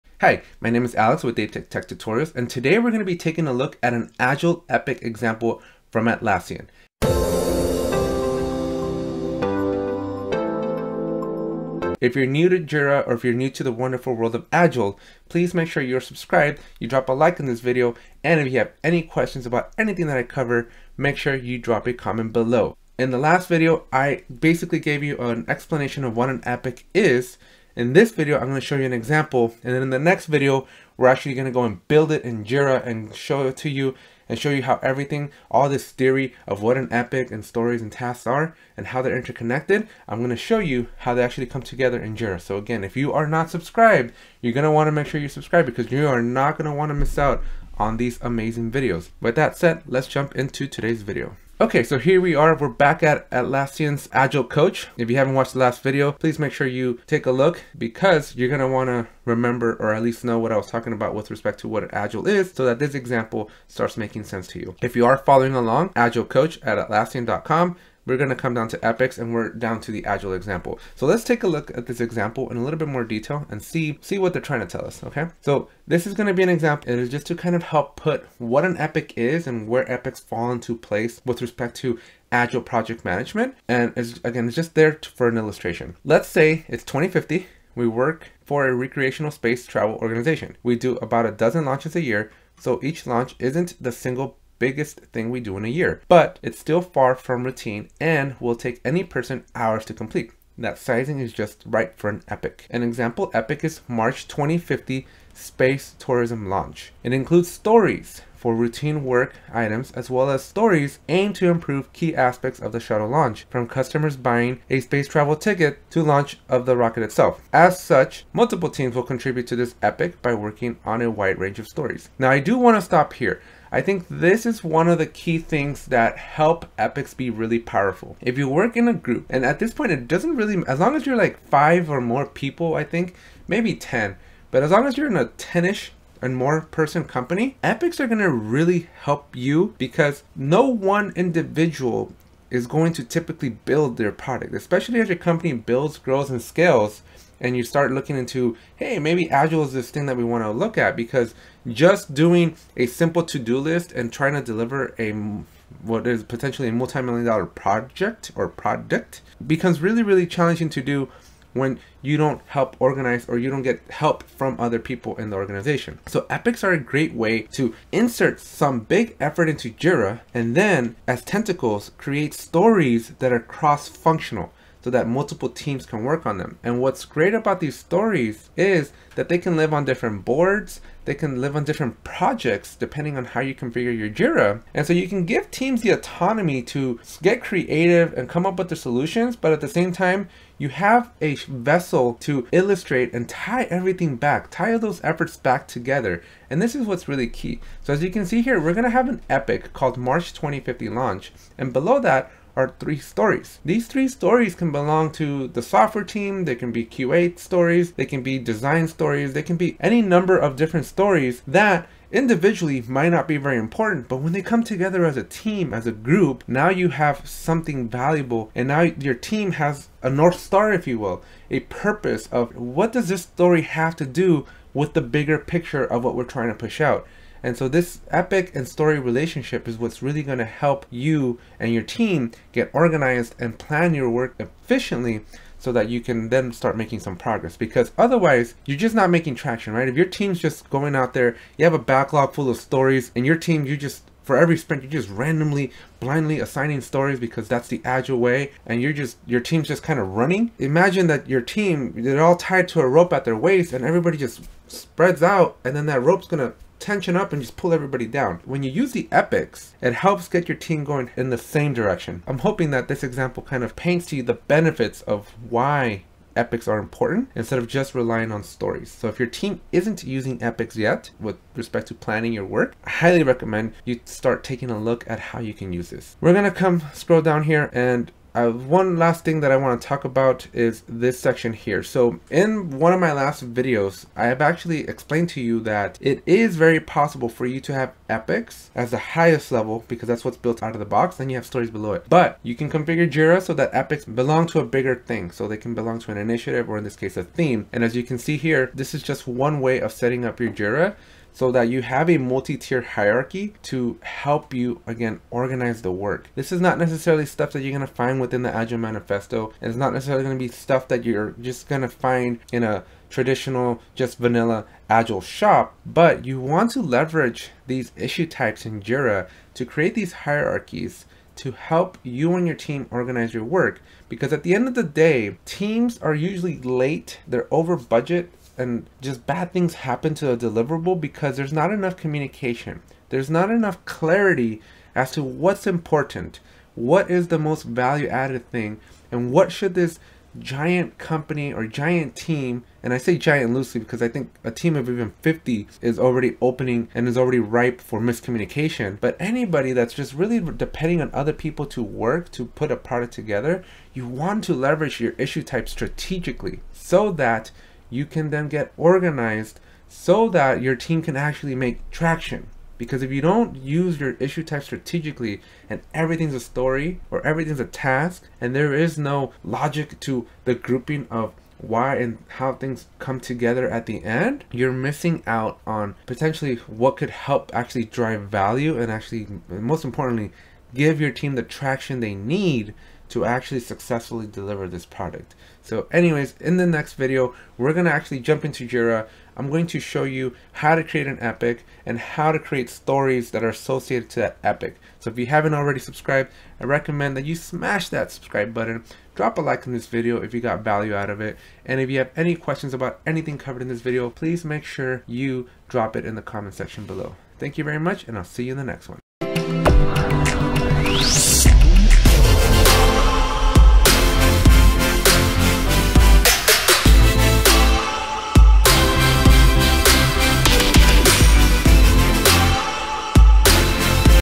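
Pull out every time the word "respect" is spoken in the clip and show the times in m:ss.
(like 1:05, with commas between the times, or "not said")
1:01, 1:21, 4:31.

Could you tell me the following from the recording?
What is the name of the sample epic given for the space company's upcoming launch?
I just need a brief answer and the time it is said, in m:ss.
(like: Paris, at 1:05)
March 2050 space tourism launch, at 1:43.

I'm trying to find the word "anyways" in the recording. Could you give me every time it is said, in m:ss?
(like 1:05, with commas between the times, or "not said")
6:25.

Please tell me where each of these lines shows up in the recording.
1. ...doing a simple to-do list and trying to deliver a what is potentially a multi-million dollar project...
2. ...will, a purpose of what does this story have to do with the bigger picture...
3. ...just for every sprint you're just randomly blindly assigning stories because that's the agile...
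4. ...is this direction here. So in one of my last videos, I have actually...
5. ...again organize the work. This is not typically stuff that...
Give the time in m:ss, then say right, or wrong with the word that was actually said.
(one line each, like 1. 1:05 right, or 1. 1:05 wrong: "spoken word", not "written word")
1. 2:32 right
2. 3:40 right
3. 4:03 right
4. 4:40 wrong: "section", not "direction"
5. 5:04 wrong: "necessarily", not "typically".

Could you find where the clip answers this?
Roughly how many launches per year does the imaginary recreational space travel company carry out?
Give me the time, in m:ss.
1:30.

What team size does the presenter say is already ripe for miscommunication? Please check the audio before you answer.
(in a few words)
50.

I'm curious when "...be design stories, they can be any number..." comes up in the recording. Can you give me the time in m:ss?
3:28.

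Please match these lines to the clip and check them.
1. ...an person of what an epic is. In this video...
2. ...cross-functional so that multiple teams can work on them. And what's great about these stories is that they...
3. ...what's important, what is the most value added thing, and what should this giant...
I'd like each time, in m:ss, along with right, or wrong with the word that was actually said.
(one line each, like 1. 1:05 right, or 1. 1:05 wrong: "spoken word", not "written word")
1. 0:25 wrong: "explanation", not "person"
2. 2:53 right
3. 5:35 right.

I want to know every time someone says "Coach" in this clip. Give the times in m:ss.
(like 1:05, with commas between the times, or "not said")
0:54, 1:06.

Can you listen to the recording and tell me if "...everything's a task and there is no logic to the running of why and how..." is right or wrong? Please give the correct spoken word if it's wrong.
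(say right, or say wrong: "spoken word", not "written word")
wrong: "grouping", not "running".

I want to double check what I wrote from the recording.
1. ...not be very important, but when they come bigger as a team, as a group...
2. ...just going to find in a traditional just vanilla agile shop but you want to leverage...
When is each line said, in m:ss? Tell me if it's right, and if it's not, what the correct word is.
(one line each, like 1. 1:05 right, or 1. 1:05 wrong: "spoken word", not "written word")
1. 3:33 wrong: "together", not "bigger"
2. 5:11 right.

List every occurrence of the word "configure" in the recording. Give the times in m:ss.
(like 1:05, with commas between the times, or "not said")
3:03, 4:52.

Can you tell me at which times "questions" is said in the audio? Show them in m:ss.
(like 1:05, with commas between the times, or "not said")
0:19, 6:42.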